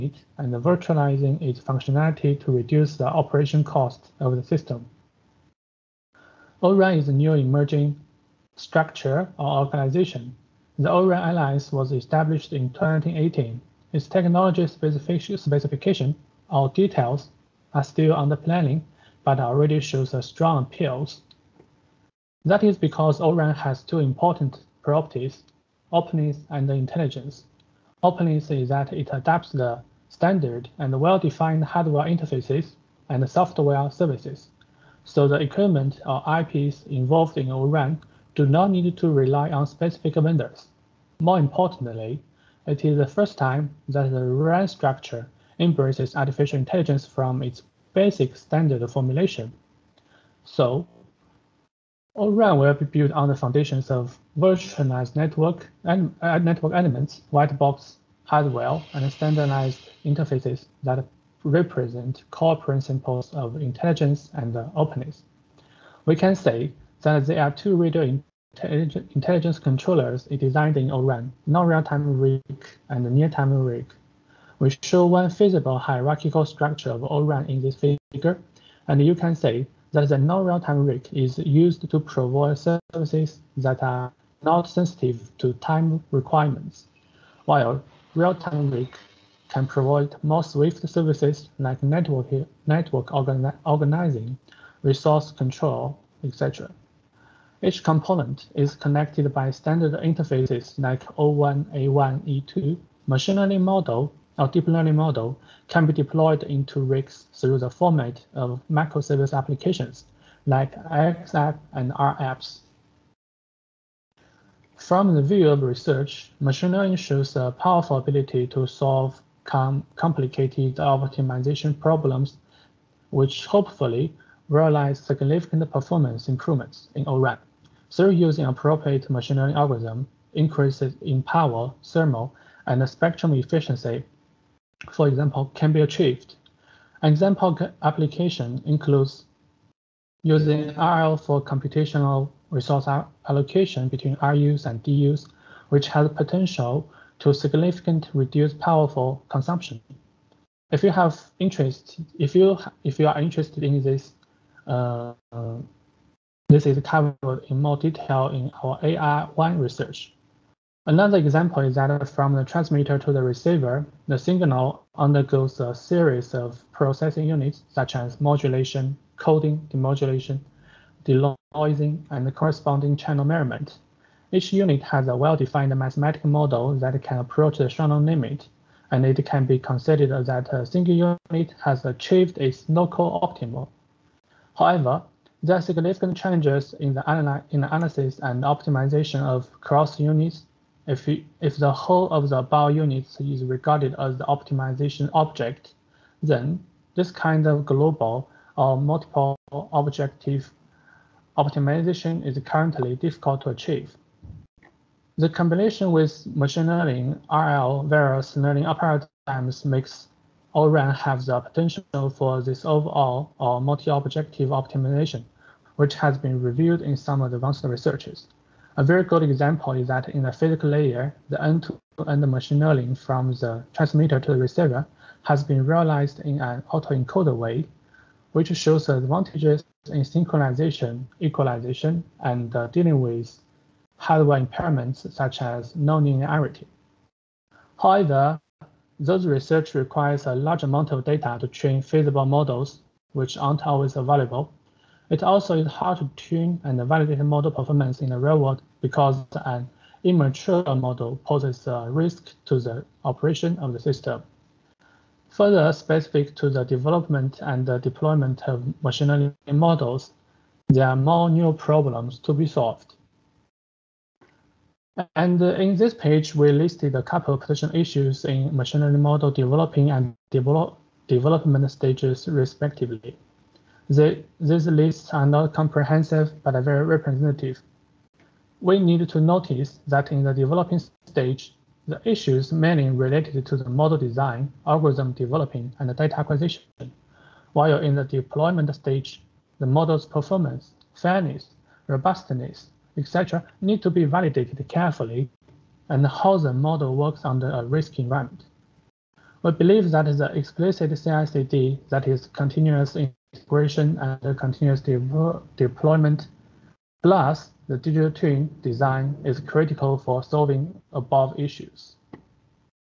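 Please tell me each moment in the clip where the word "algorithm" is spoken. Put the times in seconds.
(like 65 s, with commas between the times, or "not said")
129 s, 284 s.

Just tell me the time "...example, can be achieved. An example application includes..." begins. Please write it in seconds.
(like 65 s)
135 s.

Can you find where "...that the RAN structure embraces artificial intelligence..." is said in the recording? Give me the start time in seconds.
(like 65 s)
43 s.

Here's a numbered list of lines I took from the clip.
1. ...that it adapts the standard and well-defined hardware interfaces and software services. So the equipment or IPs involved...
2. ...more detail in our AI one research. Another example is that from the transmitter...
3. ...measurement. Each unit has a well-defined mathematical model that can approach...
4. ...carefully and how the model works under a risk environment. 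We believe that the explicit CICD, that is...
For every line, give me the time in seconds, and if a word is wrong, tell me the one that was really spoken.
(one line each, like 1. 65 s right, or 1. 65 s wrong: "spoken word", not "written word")
1. 28 s right
2. 157 s right
3. 173 s right
4. 294 s right.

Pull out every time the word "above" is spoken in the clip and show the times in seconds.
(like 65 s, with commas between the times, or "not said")
310 s.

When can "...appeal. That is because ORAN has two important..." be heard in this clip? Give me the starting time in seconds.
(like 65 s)
20 s.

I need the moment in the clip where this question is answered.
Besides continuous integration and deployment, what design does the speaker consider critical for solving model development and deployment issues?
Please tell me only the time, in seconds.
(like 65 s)
307 s.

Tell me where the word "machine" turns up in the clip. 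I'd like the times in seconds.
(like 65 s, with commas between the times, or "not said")
103 s, 116 s, 129 s, 206 s, 222 s, 258 s, 268 s.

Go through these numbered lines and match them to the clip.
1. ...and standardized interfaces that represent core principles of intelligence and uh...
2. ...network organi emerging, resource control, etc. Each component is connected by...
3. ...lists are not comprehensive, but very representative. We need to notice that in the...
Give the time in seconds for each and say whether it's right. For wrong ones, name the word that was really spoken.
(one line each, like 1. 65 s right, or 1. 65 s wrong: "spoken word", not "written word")
1. 58 s right
2. 92 s wrong: "organizing", not "emerging"
3. 274 s right.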